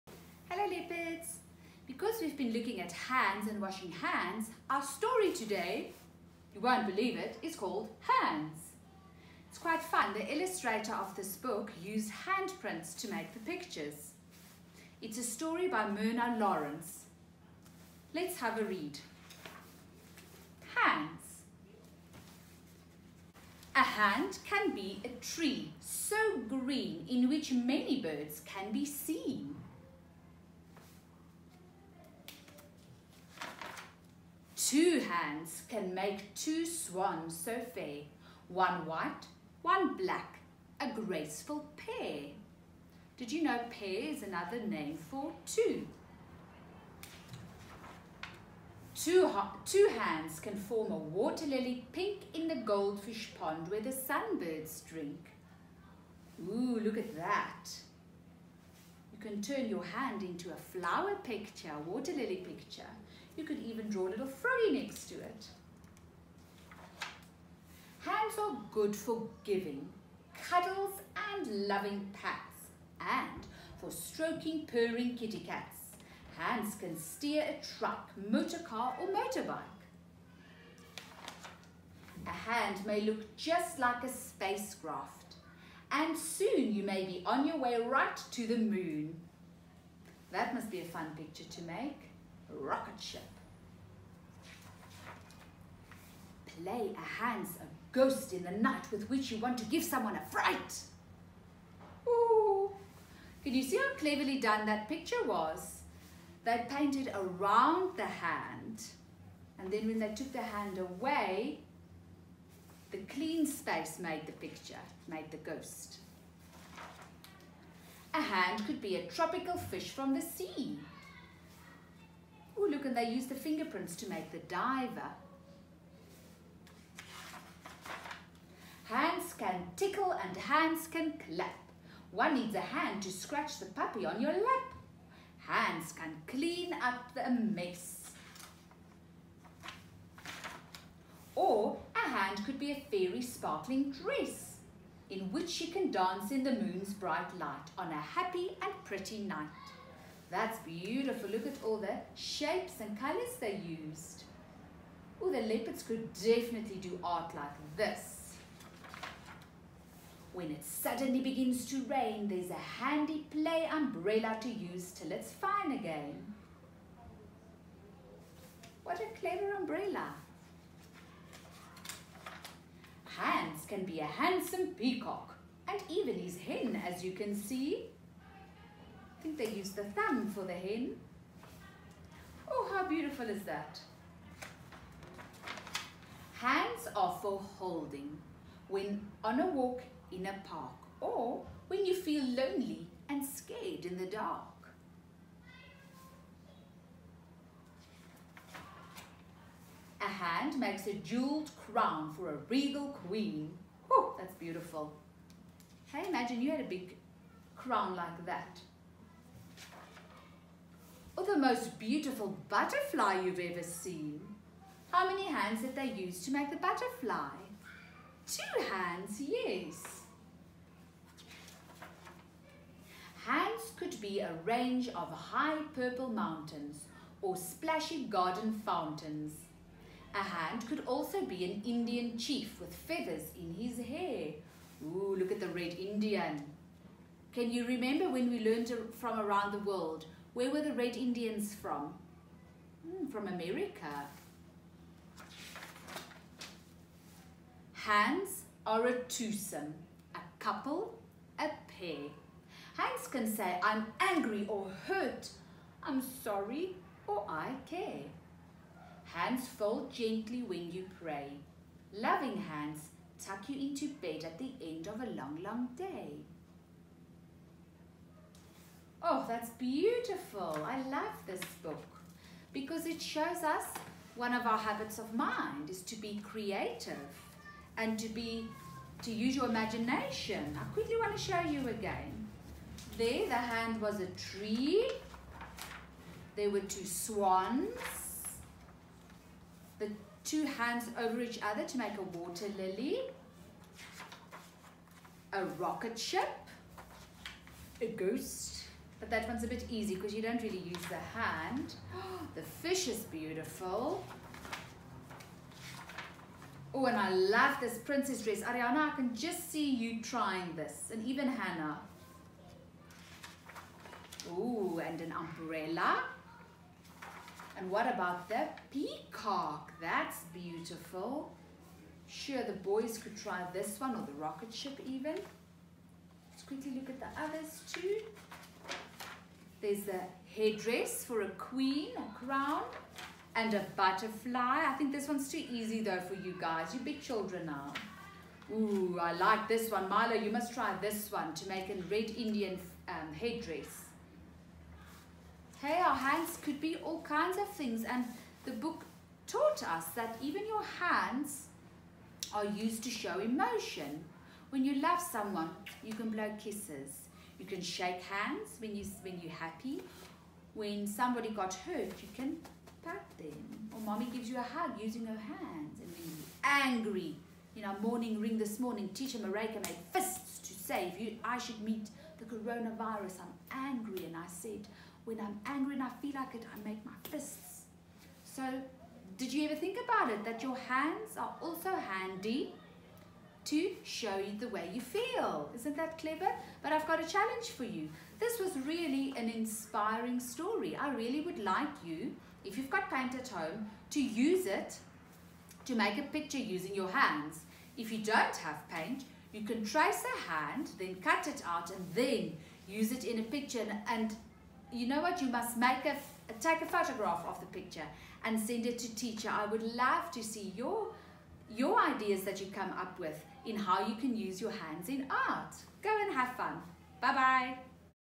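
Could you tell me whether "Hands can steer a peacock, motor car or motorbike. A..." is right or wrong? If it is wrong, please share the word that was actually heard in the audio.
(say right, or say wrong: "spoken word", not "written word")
wrong: "truck", not "peacock".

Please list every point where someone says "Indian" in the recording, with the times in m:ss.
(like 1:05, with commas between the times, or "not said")
3:51, 3:55, 4:00, 5:42.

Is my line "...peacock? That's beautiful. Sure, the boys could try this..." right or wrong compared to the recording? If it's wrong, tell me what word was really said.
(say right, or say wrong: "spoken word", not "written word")
right.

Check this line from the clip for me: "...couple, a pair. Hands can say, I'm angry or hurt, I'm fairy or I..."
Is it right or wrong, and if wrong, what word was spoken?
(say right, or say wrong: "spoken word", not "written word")
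wrong: "sorry", not "fairy".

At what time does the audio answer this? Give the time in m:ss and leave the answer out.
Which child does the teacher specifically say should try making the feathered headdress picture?
5:39.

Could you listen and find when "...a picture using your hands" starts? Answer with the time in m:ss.
6:35.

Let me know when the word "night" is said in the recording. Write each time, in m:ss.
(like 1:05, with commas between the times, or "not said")
1:38, 2:29.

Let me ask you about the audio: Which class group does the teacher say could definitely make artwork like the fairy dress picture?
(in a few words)
The leopards.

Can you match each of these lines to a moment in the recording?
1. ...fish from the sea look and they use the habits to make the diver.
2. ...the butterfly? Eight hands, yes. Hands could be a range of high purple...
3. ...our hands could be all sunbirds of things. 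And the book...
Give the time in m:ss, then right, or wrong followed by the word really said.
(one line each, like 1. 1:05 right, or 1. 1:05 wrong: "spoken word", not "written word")
1. 1:59 wrong: "fingerprints", not "habits"
2. 3:36 wrong: "Two", not "Eight"
3. 5:45 wrong: "kinds", not "sunbirds".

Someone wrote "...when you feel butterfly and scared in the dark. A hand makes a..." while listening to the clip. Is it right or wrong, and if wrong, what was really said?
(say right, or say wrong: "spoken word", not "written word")
wrong: "lonely", not "butterfly".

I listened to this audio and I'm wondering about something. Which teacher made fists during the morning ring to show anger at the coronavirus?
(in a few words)
Teacher Mareka.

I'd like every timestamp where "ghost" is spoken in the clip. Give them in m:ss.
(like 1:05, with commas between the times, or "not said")
1:37, 1:55, 4:57.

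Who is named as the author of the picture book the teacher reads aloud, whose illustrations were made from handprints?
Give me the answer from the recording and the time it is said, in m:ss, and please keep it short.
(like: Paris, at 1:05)
Myrna Lawrence, at 0:15.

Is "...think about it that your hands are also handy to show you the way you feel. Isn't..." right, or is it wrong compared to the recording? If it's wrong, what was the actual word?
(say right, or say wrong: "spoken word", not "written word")
right.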